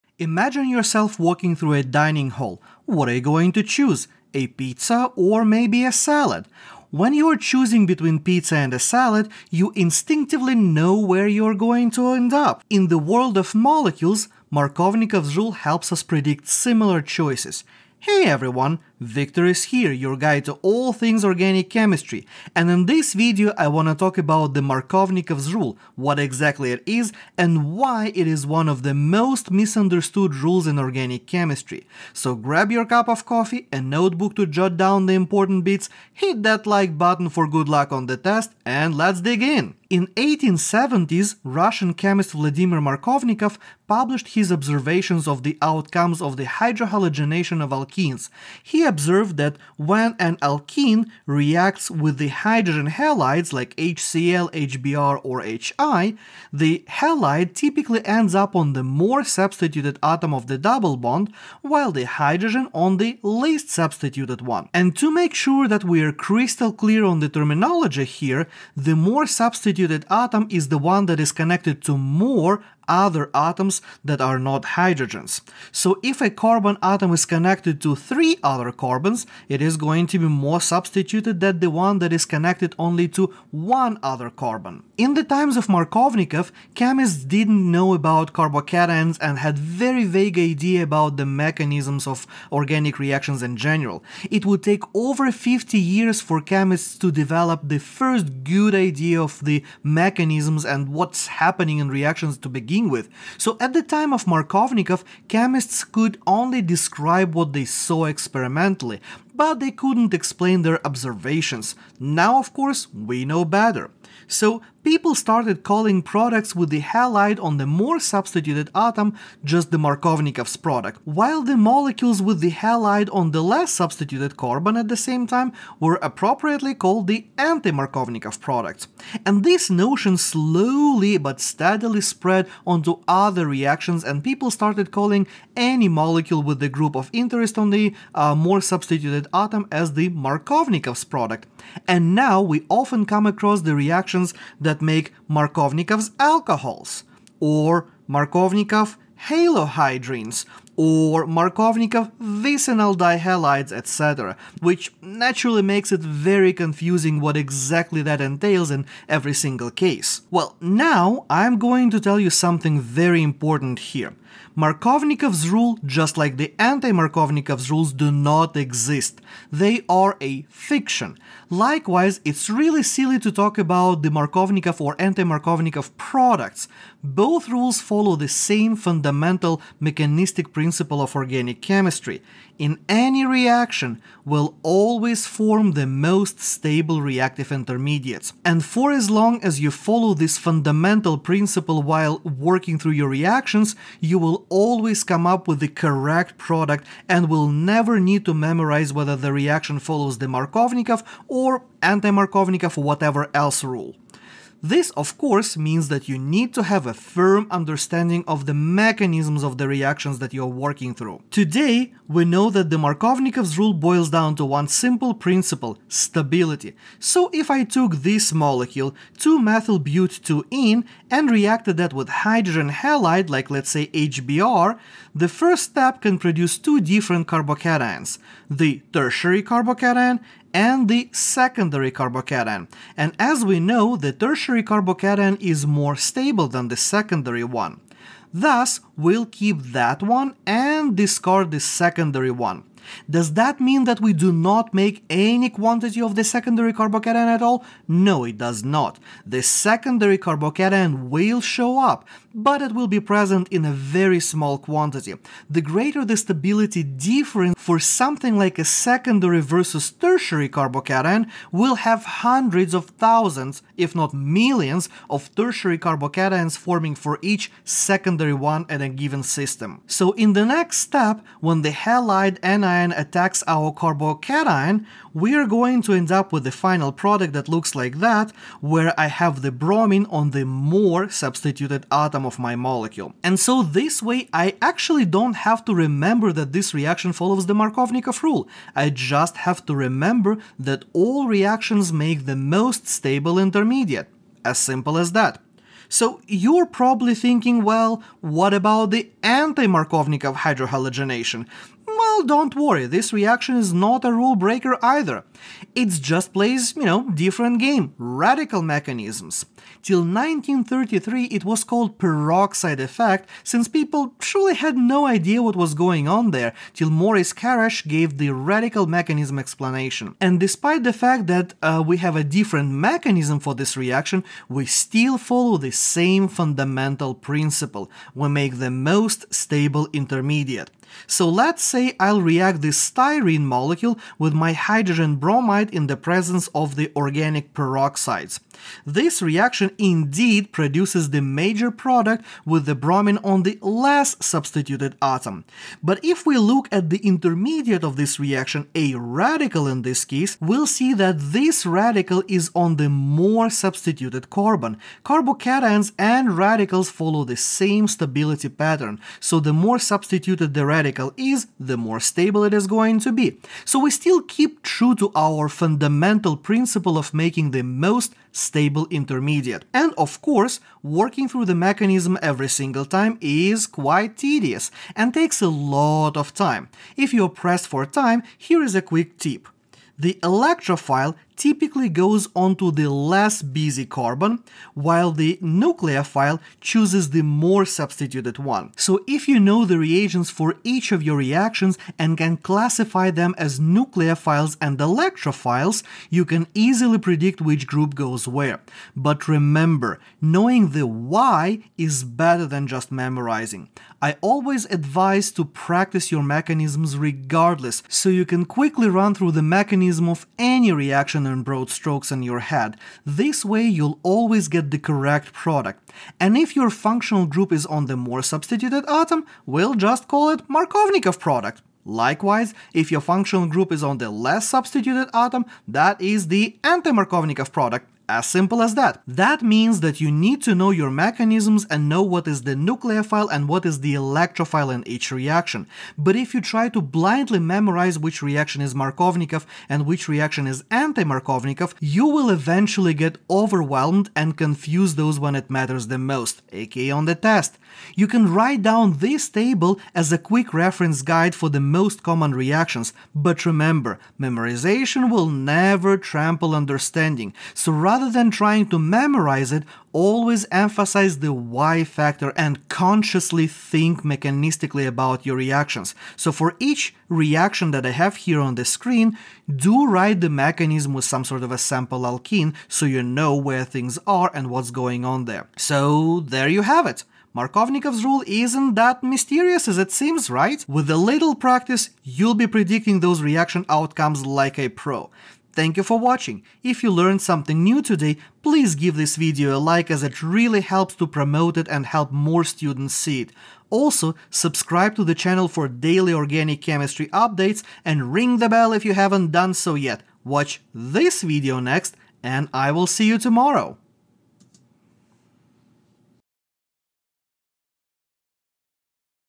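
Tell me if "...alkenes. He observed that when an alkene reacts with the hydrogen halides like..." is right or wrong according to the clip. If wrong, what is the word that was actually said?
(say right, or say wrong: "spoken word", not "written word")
right.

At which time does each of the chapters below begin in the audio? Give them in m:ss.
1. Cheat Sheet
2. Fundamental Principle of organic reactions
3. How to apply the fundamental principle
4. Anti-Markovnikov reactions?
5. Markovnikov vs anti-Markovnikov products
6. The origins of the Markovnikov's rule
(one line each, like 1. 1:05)
1. 6:09
2. 2:44
3. 3:31
4. 4:56
5. 1:54
6. 0:39.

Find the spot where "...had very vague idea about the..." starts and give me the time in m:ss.
1:29.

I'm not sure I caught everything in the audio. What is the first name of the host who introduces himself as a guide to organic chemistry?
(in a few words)
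Victor.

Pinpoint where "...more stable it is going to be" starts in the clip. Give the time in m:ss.
6:01.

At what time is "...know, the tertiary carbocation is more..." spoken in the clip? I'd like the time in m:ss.
3:53.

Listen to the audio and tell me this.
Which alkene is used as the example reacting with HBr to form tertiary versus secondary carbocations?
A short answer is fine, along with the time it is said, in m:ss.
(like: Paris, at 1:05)
2-methylbut-2-ene, at 3:39.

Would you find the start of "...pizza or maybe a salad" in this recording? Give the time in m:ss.
0:04.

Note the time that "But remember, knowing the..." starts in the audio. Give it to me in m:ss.
6:38.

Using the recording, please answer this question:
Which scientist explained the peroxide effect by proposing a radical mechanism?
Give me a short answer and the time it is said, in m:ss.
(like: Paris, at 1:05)
Maurice Kharasch, at 5:16.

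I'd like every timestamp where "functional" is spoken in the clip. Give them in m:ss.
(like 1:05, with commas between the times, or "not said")
6:56, 7:03.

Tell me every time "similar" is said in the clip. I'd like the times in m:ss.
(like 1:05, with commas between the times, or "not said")
0:16.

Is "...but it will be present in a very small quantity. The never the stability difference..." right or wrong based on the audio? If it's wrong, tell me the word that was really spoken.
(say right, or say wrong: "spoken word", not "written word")
wrong: "greater", not "never".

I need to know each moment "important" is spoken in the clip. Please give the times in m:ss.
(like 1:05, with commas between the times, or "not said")
0:35, 2:43.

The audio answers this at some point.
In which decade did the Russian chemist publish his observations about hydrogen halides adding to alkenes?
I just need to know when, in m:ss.
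0:40.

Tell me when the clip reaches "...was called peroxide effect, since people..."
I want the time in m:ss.
5:11.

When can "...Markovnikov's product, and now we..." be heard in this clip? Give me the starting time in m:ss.
2:20.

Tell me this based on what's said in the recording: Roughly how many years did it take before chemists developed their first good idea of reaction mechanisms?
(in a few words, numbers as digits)
over 50 years.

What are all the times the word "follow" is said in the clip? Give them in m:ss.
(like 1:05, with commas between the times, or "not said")
2:57, 3:09, 3:19, 4:47, 5:25, 5:56.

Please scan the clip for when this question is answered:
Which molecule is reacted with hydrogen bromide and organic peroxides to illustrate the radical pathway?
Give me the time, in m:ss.
5:32.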